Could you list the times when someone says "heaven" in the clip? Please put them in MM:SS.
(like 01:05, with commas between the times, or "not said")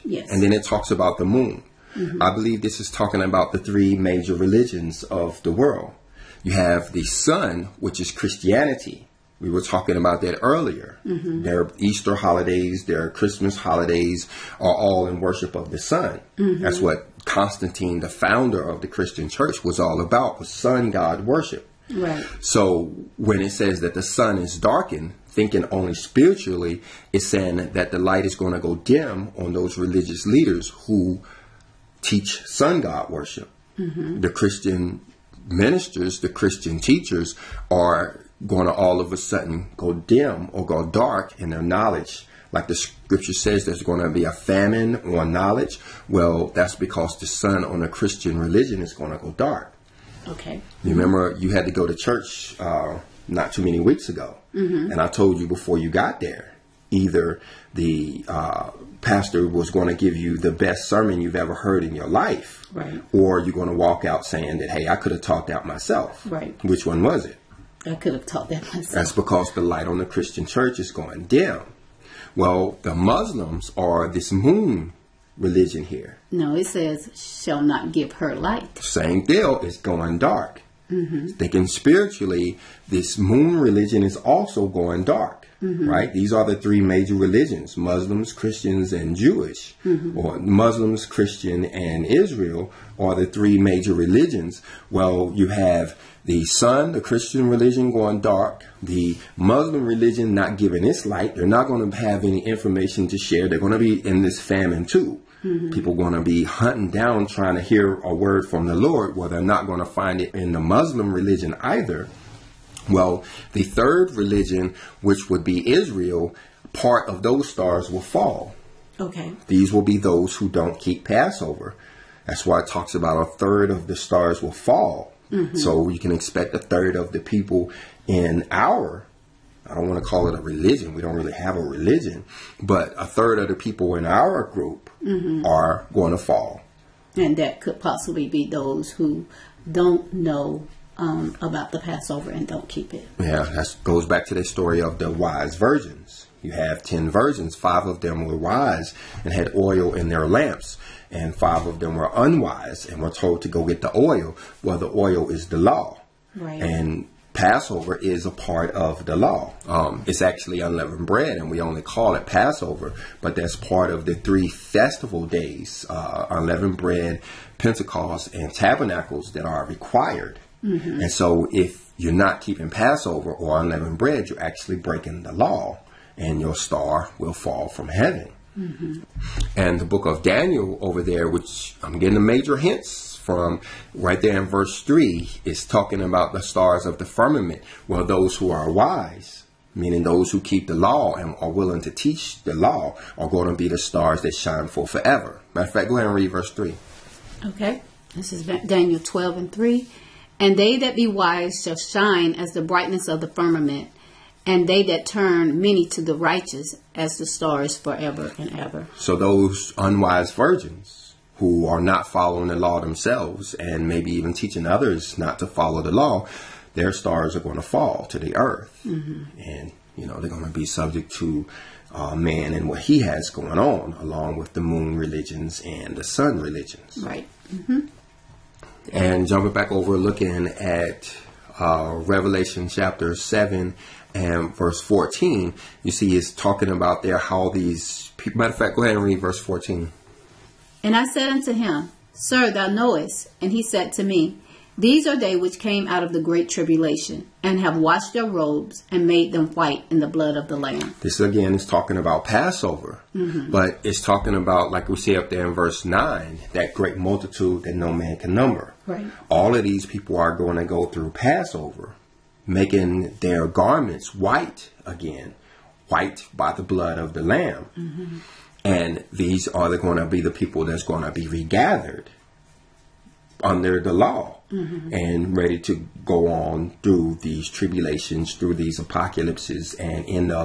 02:57.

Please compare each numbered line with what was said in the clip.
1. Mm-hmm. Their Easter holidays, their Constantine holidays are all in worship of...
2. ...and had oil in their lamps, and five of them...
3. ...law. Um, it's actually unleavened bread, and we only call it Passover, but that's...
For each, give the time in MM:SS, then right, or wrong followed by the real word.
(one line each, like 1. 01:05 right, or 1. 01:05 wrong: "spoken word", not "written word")
1. 00:11 wrong: "Christmas", not "Constantine"
2. 02:29 right
3. 02:39 right.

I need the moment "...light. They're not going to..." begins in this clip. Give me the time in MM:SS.
01:41.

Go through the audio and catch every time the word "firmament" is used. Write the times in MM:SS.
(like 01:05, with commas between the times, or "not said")
03:07, 03:23.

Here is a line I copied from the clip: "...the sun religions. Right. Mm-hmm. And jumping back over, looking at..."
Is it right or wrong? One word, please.
right.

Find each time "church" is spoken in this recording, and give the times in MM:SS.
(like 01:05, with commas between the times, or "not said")
00:19, 00:51, 01:10.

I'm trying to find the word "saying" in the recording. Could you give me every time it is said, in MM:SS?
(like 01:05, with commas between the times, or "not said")
00:27, 01:04.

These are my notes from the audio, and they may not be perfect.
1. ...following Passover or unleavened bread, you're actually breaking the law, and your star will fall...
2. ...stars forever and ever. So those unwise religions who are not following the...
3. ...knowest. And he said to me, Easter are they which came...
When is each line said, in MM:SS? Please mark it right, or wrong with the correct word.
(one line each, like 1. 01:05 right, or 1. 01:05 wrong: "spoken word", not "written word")
1. 02:52 wrong: "keeping", not "following"
2. 03:27 wrong: "virgins", not "religions"
3. 04:02 wrong: "These", not "Easter".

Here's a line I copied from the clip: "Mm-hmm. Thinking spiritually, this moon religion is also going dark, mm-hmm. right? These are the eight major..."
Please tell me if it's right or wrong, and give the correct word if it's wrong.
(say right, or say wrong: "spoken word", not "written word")
wrong: "three", not "eight".